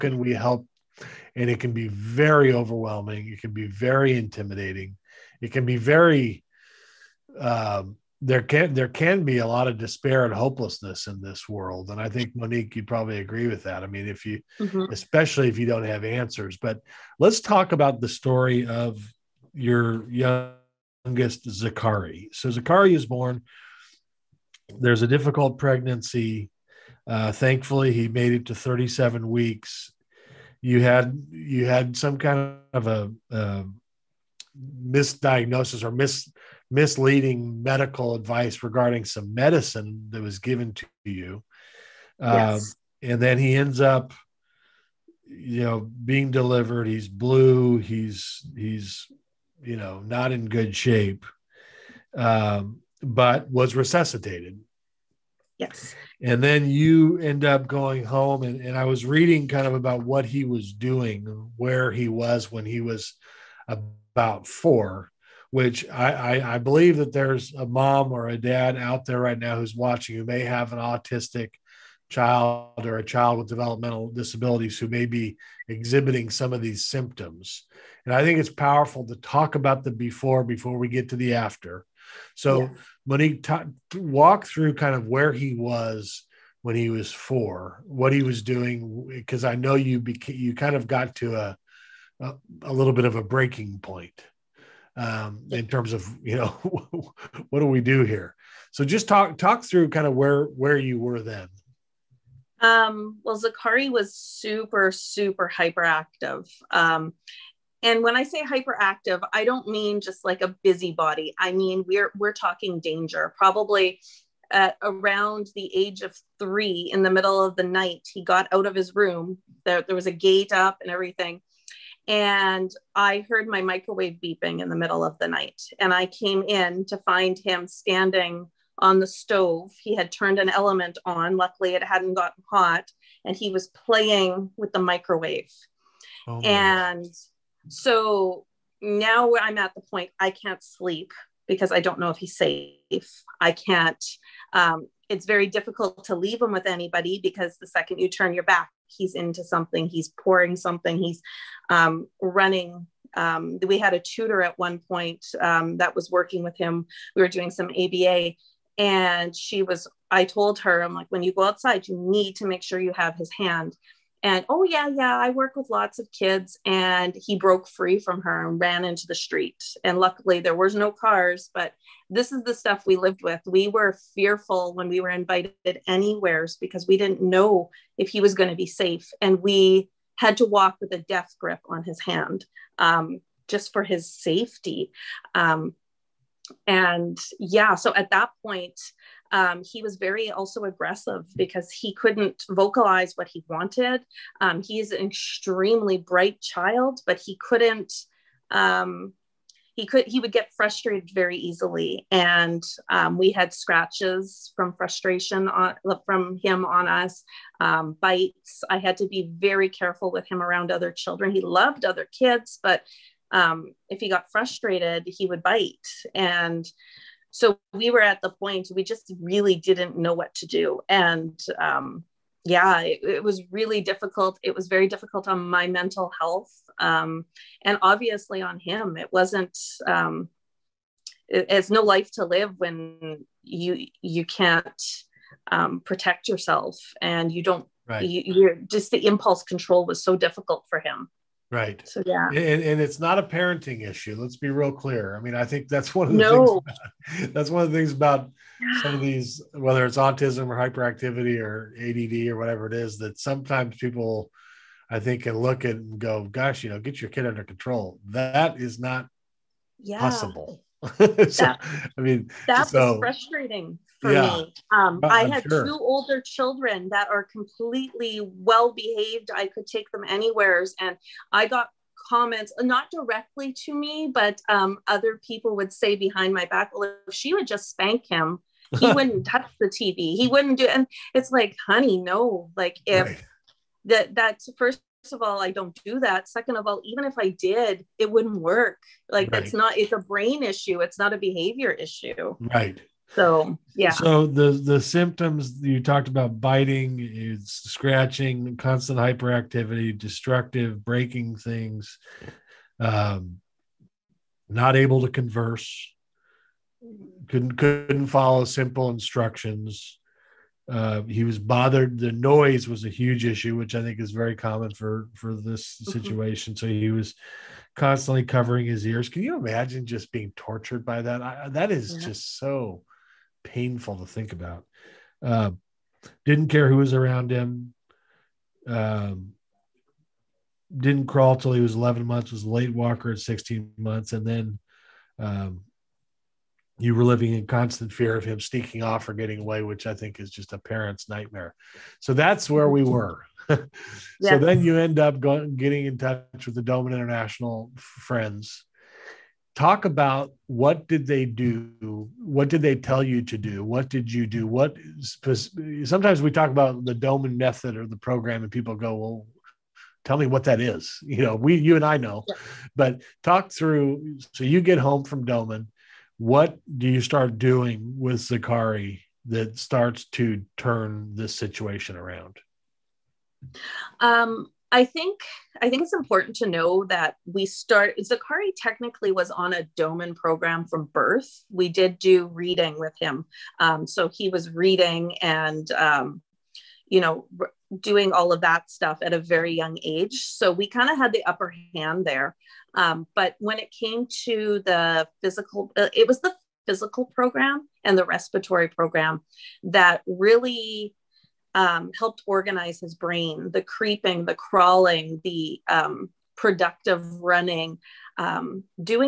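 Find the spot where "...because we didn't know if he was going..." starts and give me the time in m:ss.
2:56.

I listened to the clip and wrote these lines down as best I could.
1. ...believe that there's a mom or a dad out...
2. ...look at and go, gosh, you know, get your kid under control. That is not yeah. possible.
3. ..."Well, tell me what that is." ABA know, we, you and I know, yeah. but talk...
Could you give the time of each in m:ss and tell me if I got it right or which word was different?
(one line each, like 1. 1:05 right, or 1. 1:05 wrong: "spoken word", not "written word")
1. 1:06 right
2. 4:15 right
3. 5:58 wrong: "You", not "ABA".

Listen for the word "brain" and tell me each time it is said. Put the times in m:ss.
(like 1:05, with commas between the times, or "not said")
4:49, 6:42.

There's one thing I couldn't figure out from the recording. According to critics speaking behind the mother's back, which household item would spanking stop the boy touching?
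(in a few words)
TV.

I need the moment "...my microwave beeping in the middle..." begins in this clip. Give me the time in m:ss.
2:03.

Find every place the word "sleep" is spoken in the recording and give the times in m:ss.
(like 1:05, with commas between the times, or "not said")
2:20.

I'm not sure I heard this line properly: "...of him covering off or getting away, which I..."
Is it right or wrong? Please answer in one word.
wrong.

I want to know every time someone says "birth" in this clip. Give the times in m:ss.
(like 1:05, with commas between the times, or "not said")
6:20.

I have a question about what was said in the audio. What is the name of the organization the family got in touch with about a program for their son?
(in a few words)
Doman International.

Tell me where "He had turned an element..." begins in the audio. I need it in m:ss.
2:09.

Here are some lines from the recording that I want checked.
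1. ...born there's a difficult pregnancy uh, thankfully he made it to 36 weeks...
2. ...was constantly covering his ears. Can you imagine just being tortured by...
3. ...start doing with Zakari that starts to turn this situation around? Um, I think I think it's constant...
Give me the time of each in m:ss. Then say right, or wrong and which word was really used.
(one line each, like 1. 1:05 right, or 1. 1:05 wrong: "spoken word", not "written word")
1. 0:23 wrong: "37", not "36"
2. 5:16 right
3. 6:07 wrong: "important", not "constant".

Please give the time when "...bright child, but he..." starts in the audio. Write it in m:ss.
3:15.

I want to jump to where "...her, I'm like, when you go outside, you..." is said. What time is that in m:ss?
2:40.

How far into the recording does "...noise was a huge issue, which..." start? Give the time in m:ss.
5:12.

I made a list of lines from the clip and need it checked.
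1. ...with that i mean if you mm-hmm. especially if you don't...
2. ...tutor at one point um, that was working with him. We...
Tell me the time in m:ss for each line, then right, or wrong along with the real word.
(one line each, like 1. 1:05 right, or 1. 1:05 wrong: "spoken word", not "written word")
1. 0:13 right
2. 2:34 right.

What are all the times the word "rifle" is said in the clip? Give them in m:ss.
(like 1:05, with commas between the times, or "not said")
not said.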